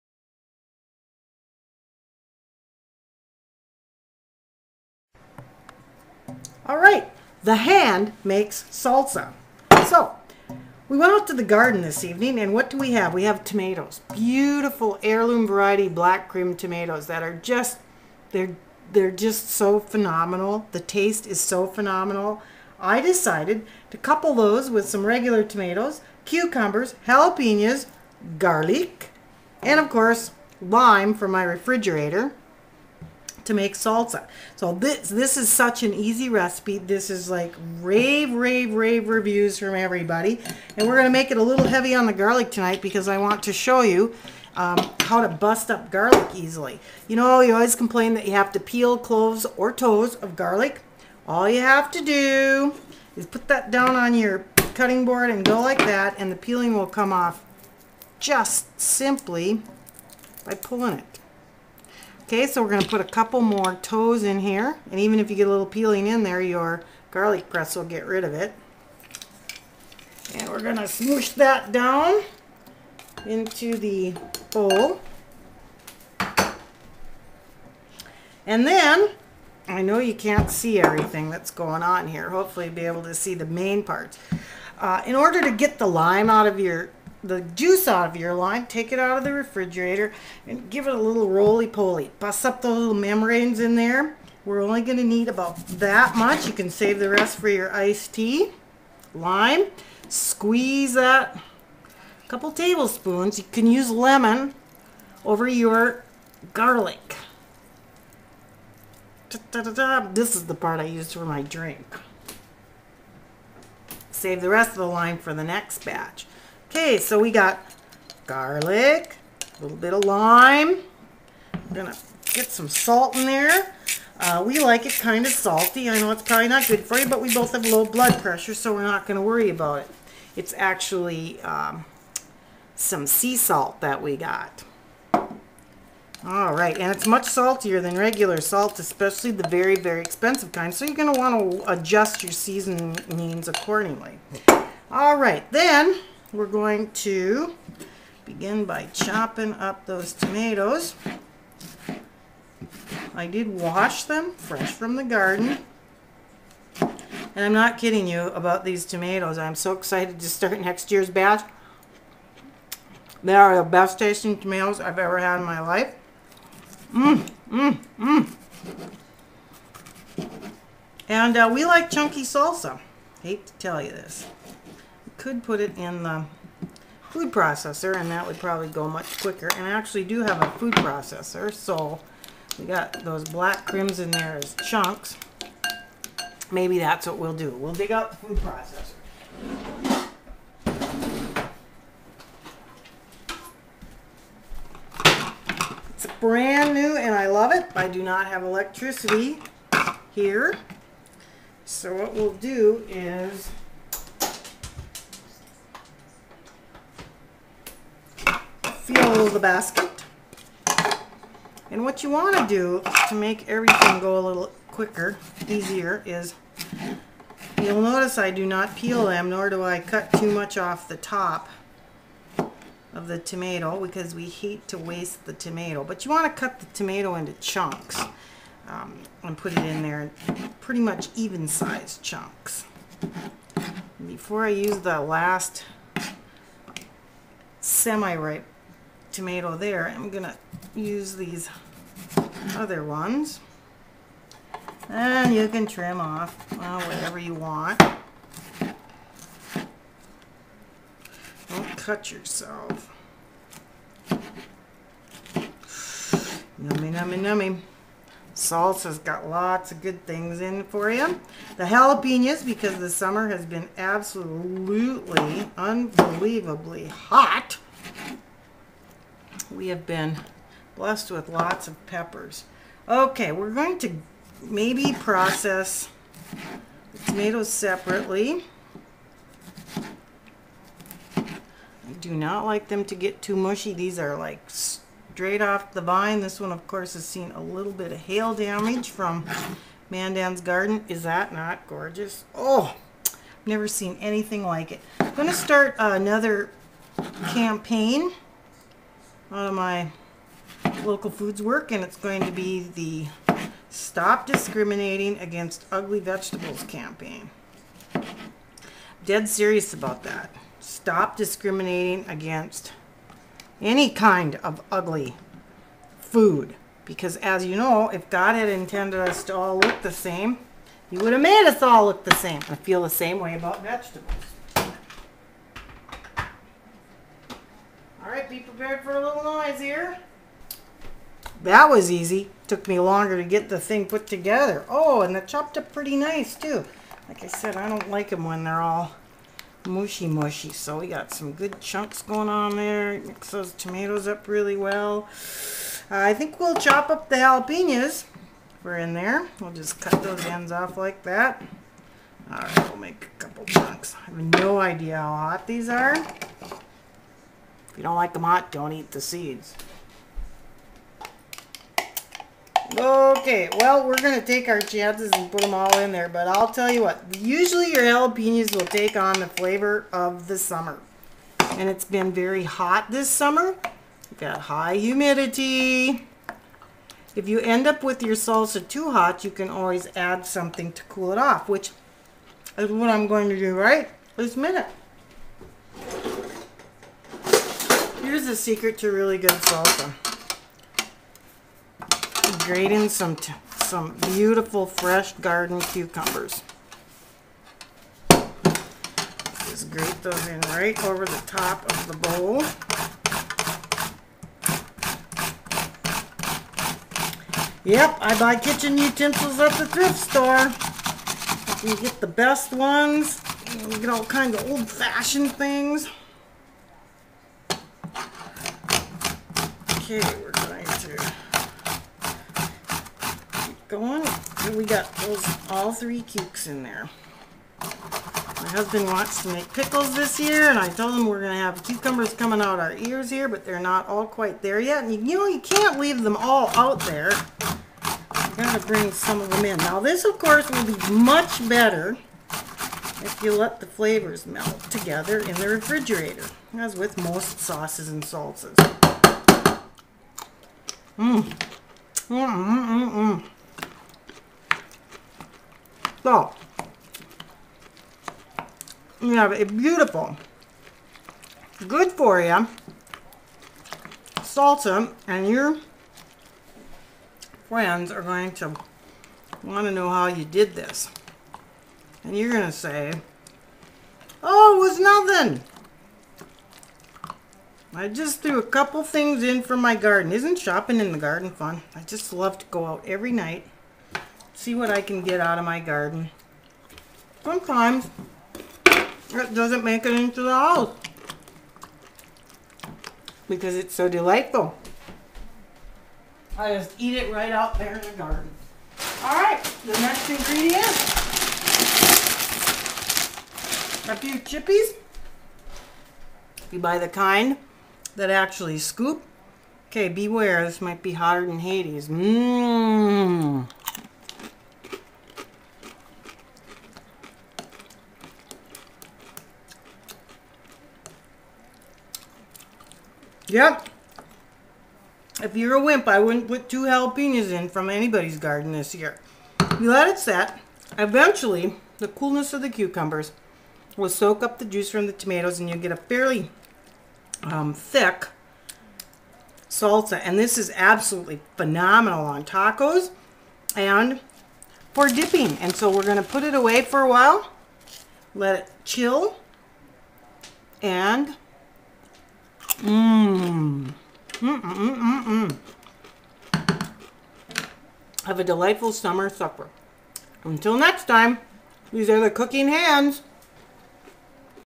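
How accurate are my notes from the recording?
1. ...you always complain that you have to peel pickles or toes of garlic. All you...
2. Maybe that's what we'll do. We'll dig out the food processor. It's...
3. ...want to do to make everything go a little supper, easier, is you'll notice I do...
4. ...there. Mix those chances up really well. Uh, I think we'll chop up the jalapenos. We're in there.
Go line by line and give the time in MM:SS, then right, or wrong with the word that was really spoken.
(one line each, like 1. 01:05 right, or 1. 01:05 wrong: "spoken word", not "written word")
1. 00:47 wrong: "cloves", not "pickles"
2. 03:06 right
3. 03:32 wrong: "quicker", not "supper"
4. 05:42 wrong: "tomatoes", not "chances".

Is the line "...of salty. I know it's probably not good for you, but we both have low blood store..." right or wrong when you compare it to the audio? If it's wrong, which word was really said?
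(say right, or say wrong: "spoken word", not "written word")
wrong: "pressure", not "store".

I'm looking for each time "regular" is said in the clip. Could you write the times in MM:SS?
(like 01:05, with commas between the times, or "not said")
00:25, 02:17.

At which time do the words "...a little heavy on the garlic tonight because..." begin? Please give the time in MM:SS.
00:41.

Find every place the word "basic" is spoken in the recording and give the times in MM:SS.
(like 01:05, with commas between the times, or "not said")
not said.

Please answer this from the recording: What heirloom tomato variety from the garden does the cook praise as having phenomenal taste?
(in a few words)
Black Krim.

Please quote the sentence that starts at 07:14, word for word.
And you, you know, you can't leave them all out there.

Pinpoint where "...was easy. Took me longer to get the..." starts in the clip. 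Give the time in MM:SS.
05:31.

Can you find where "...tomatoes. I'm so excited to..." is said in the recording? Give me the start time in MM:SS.
02:38.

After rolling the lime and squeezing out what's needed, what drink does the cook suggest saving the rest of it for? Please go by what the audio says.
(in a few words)
iced tea.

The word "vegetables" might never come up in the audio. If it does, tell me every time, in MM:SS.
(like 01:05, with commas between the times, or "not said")
05:06, 05:23.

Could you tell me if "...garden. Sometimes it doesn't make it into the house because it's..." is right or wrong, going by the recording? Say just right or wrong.
right.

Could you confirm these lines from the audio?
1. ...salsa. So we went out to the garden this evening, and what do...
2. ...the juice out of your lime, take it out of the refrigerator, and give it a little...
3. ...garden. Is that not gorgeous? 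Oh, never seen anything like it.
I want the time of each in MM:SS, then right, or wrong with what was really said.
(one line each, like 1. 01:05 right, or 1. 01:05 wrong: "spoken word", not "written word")
1. 00:08 right
2. 01:27 right
3. 04:50 right.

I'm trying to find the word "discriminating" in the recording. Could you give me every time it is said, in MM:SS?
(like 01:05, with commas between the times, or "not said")
05:04, 05:11.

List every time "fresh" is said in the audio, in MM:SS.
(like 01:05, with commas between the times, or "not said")
02:34, 06:34.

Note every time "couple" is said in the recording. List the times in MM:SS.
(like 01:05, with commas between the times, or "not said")
00:23, 01:03, 01:42, 05:53, 07:58.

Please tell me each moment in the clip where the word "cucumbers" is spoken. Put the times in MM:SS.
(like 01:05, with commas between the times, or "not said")
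00:26, 06:35, 07:11, 08:52.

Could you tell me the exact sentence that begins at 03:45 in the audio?
But you want to cut the tomato into chunks um, and put it in there, pretty much even sized chunks.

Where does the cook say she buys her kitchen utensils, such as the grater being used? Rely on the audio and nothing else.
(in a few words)
thrift store.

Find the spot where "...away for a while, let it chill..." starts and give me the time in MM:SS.
09:06.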